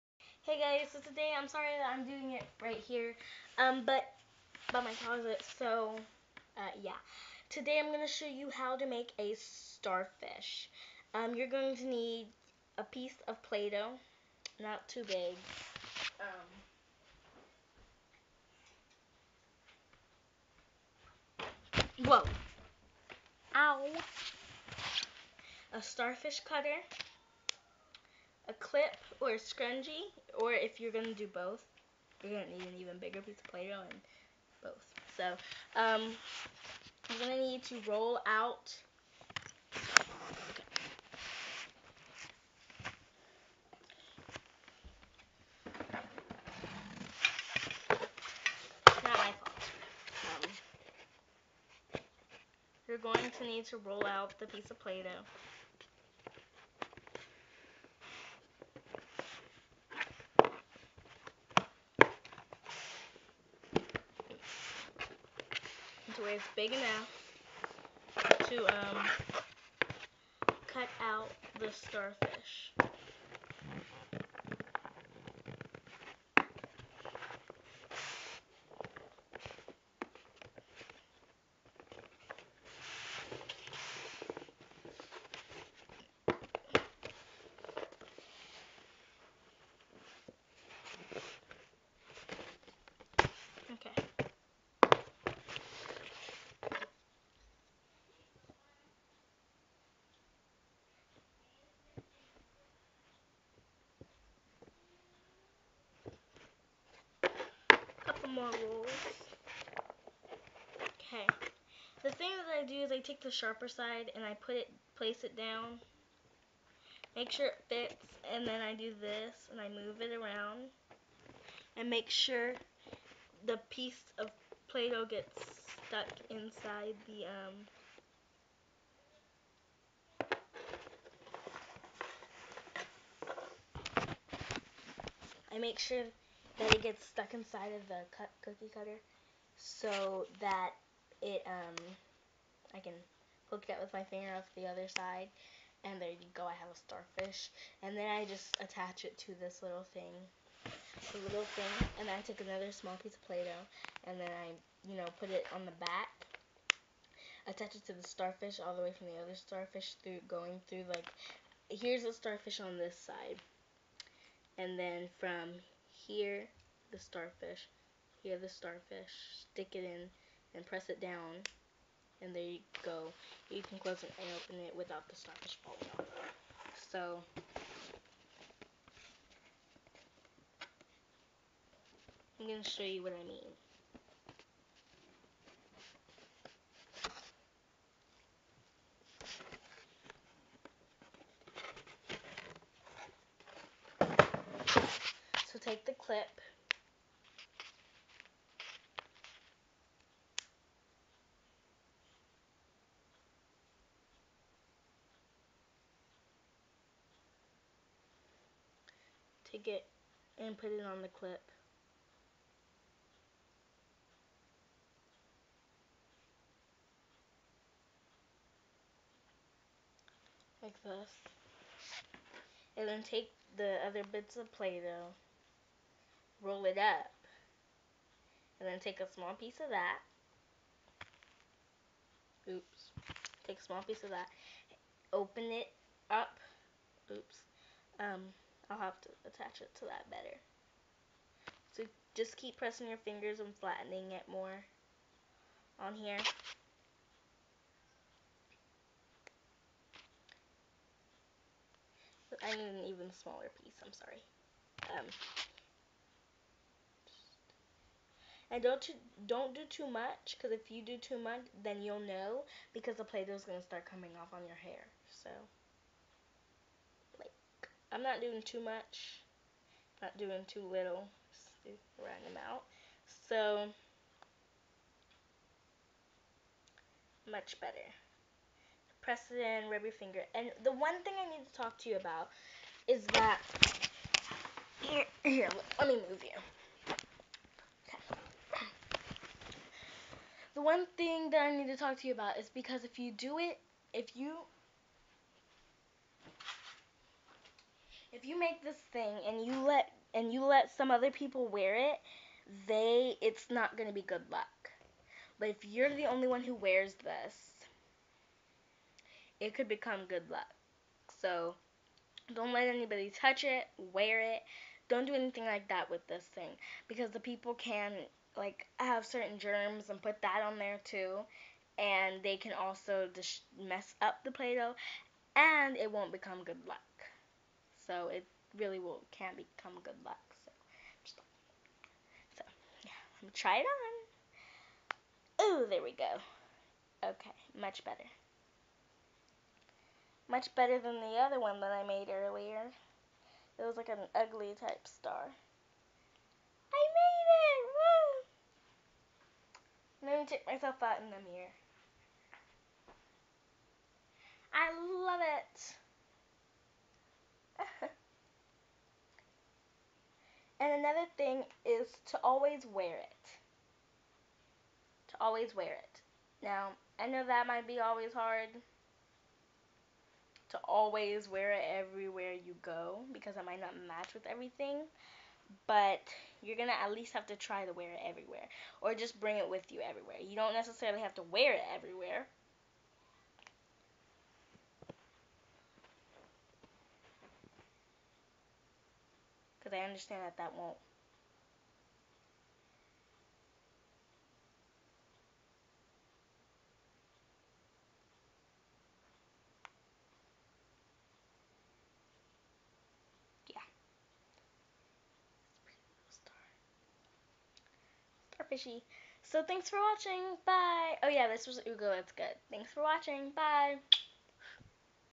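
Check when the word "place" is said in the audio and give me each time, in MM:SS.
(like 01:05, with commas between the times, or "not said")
01:54.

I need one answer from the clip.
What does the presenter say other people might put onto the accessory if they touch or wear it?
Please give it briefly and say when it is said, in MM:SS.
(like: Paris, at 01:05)
Germs, at 05:19.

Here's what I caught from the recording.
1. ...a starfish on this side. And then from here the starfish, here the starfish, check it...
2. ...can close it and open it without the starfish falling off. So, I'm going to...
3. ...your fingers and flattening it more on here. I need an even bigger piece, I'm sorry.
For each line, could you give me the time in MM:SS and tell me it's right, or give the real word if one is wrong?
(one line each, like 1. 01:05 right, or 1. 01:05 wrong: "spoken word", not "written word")
1. 02:42 wrong: "stick", not "check"
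2. 02:53 right
3. 04:02 wrong: "smaller", not "bigger".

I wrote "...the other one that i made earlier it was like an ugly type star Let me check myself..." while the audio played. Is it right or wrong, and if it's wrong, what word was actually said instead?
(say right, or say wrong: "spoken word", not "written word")
right.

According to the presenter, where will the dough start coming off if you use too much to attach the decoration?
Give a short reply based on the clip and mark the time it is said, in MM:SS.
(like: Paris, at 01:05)
Your hair, at 04:24.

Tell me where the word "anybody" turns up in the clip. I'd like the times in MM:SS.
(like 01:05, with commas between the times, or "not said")
05:12.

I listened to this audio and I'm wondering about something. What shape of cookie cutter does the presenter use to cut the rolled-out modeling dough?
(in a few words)
Starfish cutter.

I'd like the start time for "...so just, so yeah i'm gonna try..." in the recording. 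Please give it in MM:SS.
05:30.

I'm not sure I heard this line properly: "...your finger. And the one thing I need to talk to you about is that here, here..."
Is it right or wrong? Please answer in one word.
right.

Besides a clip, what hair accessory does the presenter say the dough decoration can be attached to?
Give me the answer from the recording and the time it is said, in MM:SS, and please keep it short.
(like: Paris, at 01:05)
A scrunchie, at 00:29.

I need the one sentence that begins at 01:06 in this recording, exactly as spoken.
until it's big enough to um, cut out the starfish.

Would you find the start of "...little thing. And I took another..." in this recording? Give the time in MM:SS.
02:31.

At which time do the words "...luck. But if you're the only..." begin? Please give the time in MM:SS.
05:04.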